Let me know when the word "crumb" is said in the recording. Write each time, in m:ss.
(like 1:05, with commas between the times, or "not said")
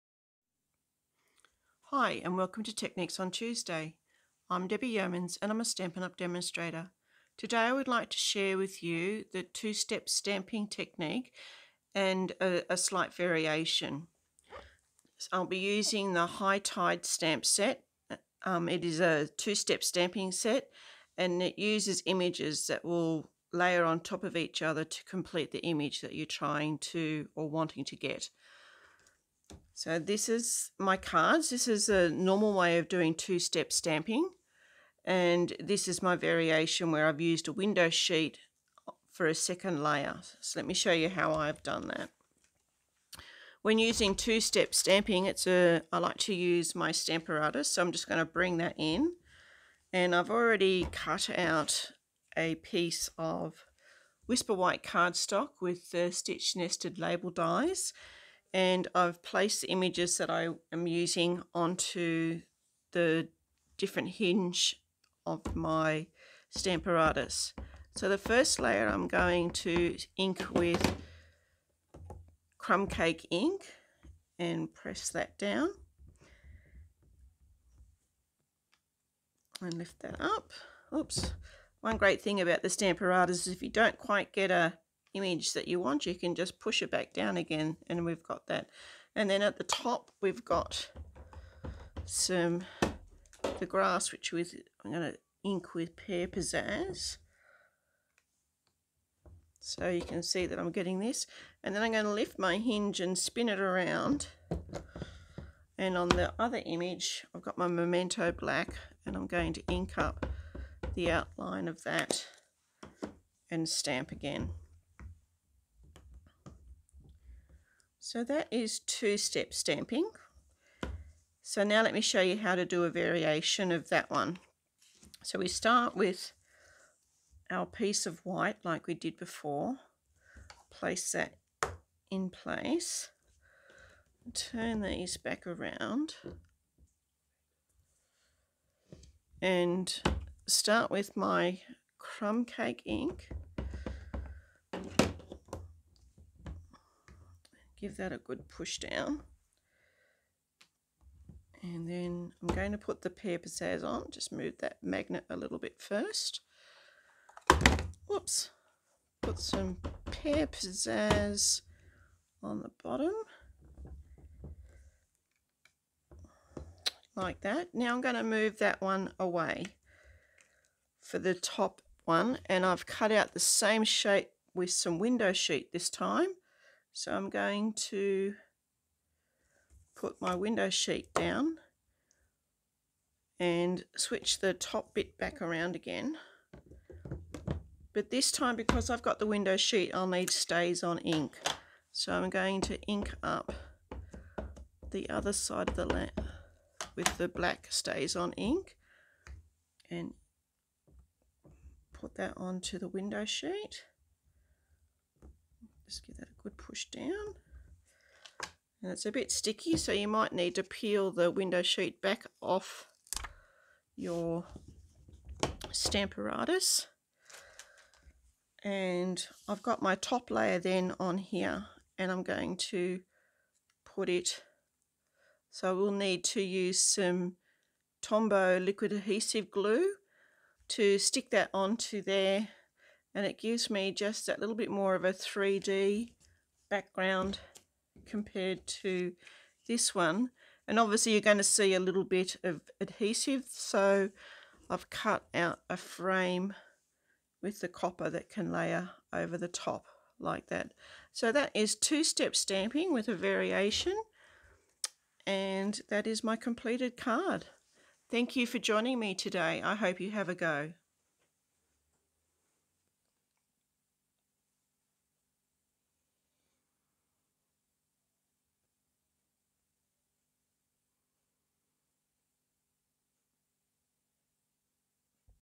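1:12, 2:21.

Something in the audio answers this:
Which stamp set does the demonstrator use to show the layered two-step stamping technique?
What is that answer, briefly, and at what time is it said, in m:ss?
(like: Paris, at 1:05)
High Tide, at 0:16.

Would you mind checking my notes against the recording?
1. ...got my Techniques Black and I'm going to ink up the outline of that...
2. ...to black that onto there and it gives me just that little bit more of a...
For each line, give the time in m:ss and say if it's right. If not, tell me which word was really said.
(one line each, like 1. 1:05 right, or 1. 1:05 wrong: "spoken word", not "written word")
1. 1:47 wrong: "Memento", not "Techniques"
2. 3:50 wrong: "stick", not "black".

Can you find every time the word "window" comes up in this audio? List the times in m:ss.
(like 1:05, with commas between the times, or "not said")
0:37, 2:54, 3:00, 3:09, 3:22, 3:31.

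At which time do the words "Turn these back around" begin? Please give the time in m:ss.
2:14.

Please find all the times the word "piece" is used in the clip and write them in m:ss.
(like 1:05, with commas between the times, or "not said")
0:52, 2:07.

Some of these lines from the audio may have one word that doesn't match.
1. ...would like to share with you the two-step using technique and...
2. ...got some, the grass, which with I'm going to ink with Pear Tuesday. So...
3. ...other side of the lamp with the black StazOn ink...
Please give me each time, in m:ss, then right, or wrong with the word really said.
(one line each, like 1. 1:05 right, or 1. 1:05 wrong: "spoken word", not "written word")
1. 0:07 wrong: "stamping", not "using"
2. 1:30 wrong: "Pizzazz", not "Tuesday"
3. 3:15 right.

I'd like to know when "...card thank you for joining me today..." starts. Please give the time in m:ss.
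4:16.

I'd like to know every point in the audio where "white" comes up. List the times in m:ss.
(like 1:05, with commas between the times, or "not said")
0:54, 2:08.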